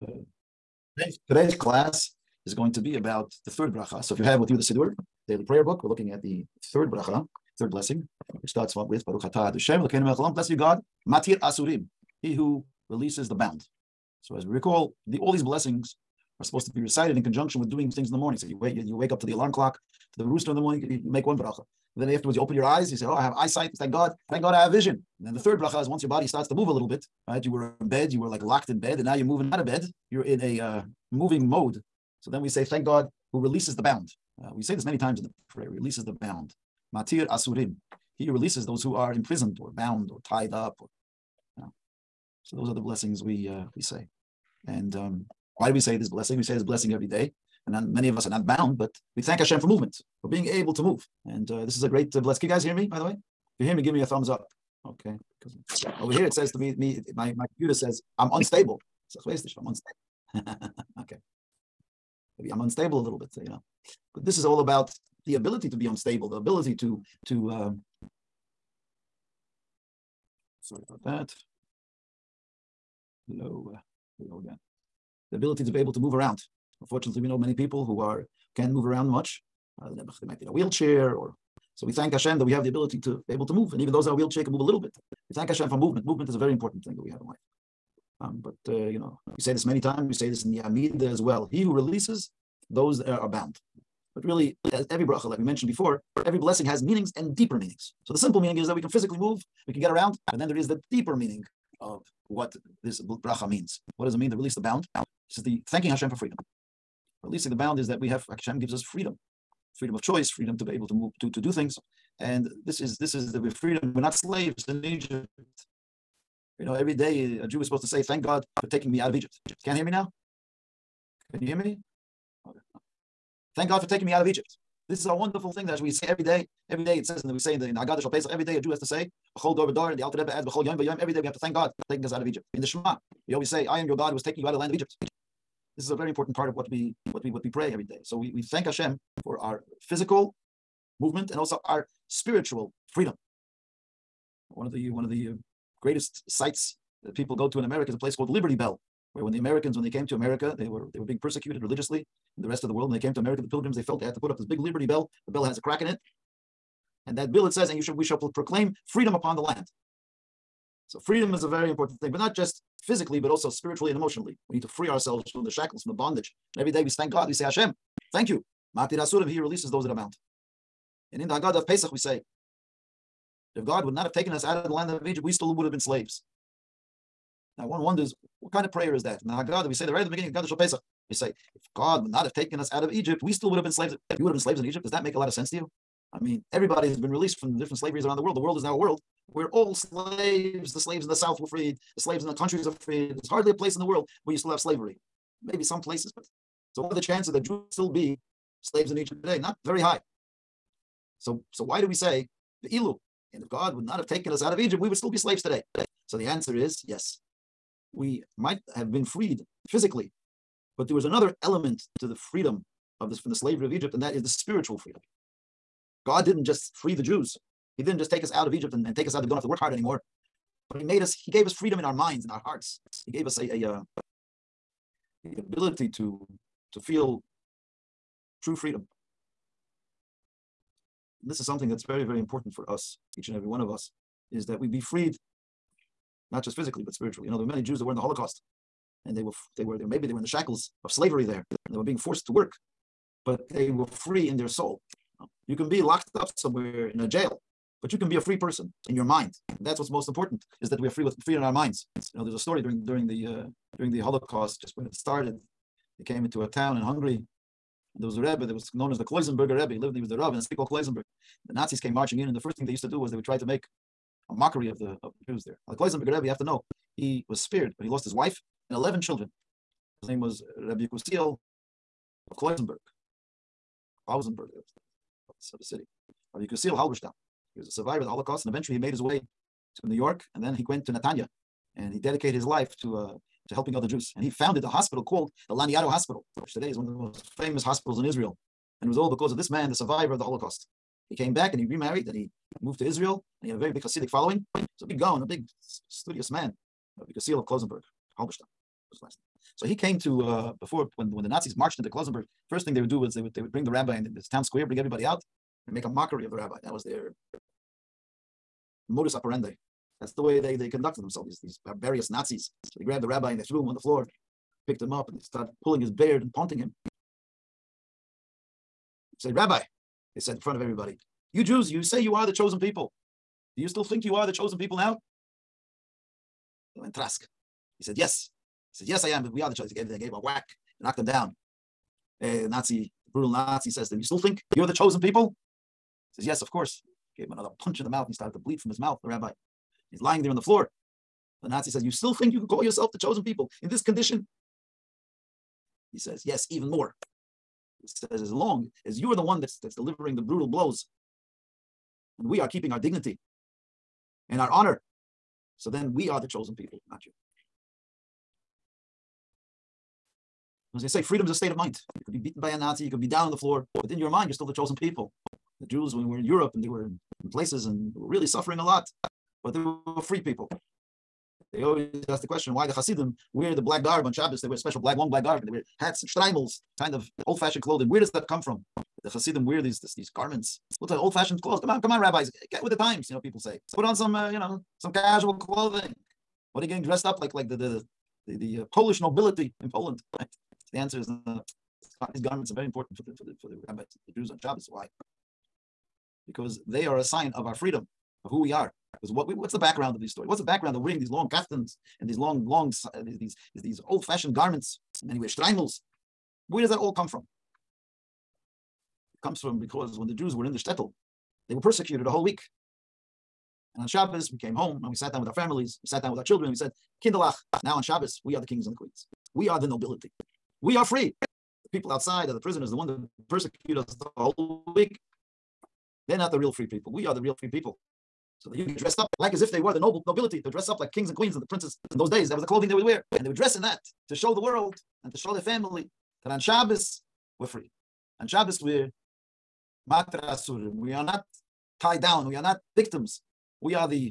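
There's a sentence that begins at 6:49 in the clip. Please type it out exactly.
It comes from because when the Jews were in the shtetl, they were persecuted a whole week.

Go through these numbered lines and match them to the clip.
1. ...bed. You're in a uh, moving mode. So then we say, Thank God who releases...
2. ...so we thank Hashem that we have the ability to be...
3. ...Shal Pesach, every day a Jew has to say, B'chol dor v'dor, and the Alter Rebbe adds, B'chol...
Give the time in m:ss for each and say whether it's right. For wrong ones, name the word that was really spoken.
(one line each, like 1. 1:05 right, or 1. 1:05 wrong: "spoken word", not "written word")
1. 0:29 right
2. 1:21 right
3. 2:07 right.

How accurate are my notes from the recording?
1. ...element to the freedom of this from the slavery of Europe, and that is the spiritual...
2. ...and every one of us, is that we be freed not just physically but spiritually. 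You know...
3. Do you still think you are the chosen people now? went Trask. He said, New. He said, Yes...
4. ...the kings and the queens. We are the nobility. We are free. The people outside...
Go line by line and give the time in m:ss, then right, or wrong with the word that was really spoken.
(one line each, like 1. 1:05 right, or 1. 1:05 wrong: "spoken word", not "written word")
1. 3:31 wrong: "Egypt", not "Europe"
2. 3:53 right
3. 5:23 wrong: "Yes", not "New"
4. 6:58 right.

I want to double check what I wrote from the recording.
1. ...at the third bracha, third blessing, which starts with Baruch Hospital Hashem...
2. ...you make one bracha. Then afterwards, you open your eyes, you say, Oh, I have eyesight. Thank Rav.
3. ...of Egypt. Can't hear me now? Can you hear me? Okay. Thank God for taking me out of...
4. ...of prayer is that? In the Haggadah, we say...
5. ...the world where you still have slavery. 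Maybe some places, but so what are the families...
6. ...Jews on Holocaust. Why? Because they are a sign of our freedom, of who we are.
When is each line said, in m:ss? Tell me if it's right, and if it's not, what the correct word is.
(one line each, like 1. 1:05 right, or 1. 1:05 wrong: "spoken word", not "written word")
1. 0:06 wrong: "Atah", not "Hospital"
2. 0:20 wrong: "God", not "Rav"
3. 1:59 right
4. 2:58 right
5. 3:13 wrong: "chances", not "families"
6. 6:34 wrong: "Shabbos", not "Holocaust".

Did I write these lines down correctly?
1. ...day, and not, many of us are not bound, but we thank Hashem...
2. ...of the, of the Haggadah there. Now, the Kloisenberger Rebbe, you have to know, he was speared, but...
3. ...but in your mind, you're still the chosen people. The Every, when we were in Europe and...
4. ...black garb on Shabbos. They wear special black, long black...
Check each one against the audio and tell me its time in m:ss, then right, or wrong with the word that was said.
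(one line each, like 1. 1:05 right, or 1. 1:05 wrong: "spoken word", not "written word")
1. 0:47 right
2. 4:24 wrong: "Jews", not "Haggadah"
3. 6:03 wrong: "Jews", not "Every"
4. 6:13 right.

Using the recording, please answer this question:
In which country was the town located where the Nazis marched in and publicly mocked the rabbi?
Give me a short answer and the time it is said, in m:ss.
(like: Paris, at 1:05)
Hungary, at 4:16.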